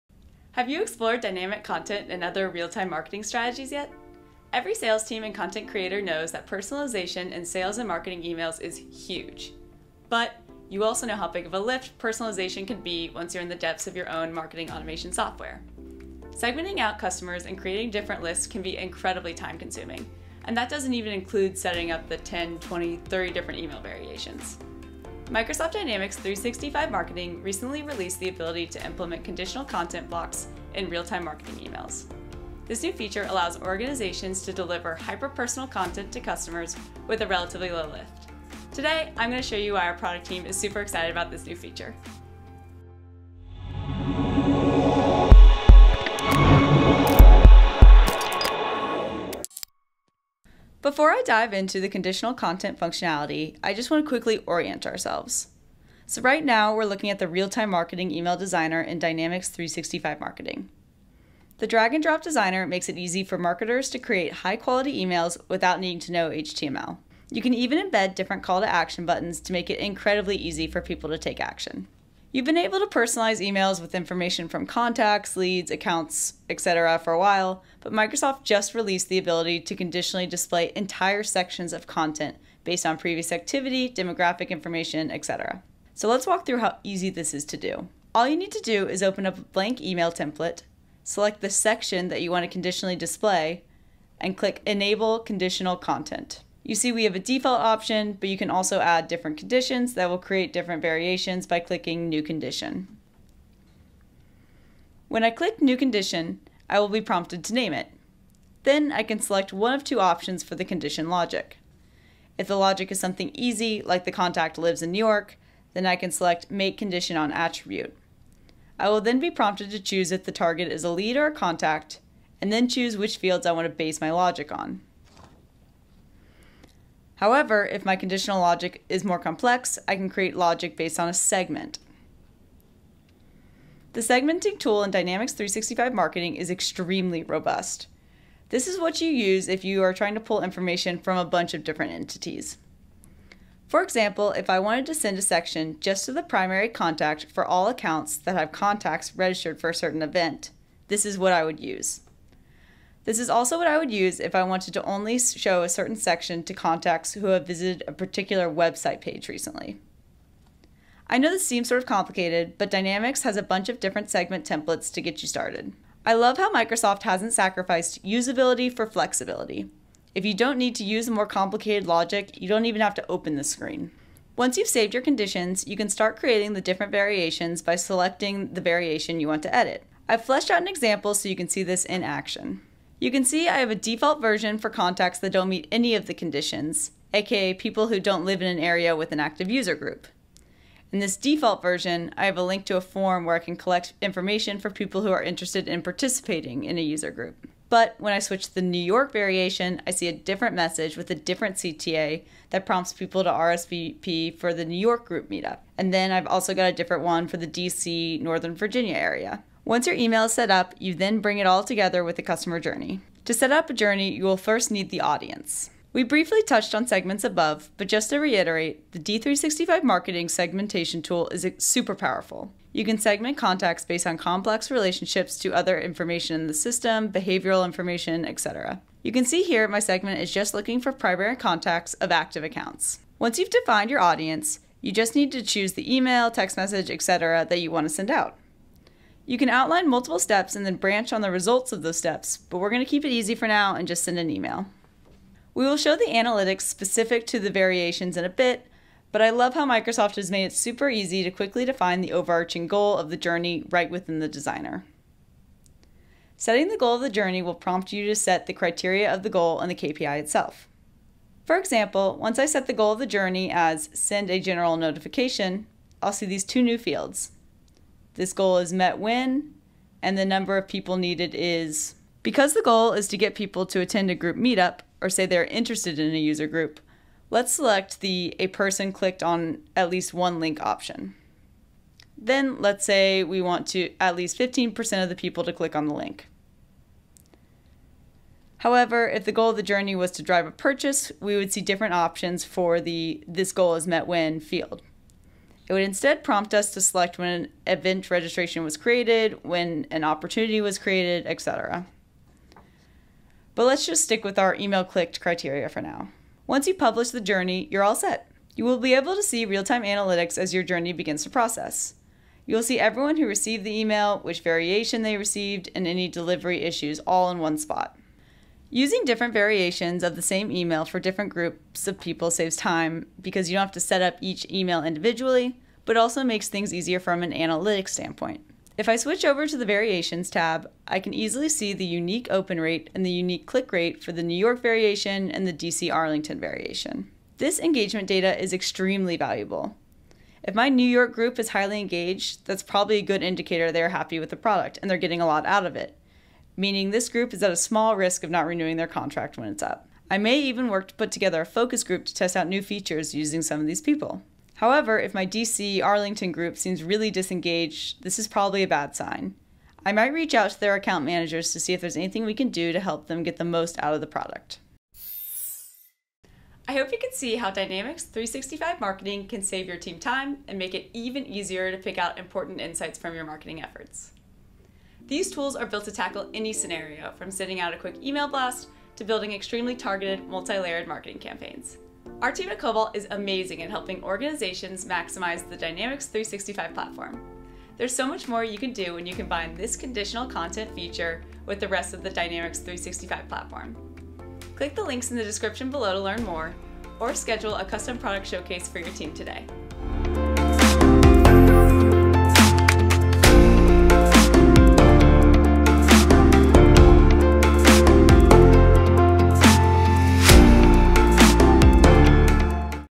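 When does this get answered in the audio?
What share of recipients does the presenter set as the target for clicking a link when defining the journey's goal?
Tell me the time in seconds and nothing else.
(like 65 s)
284 s.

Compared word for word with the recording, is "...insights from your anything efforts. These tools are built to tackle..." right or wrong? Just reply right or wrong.
wrong.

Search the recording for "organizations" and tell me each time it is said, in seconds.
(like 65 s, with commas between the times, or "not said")
33 s, 384 s.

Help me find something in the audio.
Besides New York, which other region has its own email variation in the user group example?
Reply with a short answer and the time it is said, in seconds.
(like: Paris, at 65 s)
DC, Northern Virginia, at 207 s.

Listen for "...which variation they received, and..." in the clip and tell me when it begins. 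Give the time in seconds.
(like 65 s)
314 s.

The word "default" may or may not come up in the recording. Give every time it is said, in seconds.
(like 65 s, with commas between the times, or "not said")
97 s, 183 s, 191 s.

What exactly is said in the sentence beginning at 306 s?
Once you publish the journey, you're all set.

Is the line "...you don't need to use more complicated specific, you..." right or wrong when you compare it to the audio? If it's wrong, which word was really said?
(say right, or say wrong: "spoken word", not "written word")
wrong: "logic", not "specific".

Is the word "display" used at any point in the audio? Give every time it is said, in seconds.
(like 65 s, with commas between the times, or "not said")
80 s, 92 s.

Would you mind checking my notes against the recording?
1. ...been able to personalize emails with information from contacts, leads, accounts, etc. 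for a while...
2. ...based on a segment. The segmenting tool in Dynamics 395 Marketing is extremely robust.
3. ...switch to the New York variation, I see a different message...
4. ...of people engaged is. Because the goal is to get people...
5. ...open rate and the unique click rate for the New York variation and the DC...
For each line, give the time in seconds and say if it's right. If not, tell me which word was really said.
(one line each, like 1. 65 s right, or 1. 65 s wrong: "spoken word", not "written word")
1. 72 s right
2. 130 s wrong: "365", not "395"
3. 198 s right
4. 270 s wrong: "needed", not "engaged"
5. 332 s right.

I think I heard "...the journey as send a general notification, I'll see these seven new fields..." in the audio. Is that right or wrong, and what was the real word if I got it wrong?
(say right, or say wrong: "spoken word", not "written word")
wrong: "two", not "seven".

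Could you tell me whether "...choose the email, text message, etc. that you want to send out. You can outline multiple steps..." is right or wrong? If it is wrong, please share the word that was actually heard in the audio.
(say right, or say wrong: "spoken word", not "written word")
right.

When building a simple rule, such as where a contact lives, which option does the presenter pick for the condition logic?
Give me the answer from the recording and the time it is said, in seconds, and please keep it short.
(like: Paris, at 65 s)
Make Condition on Attribute, at 116 s.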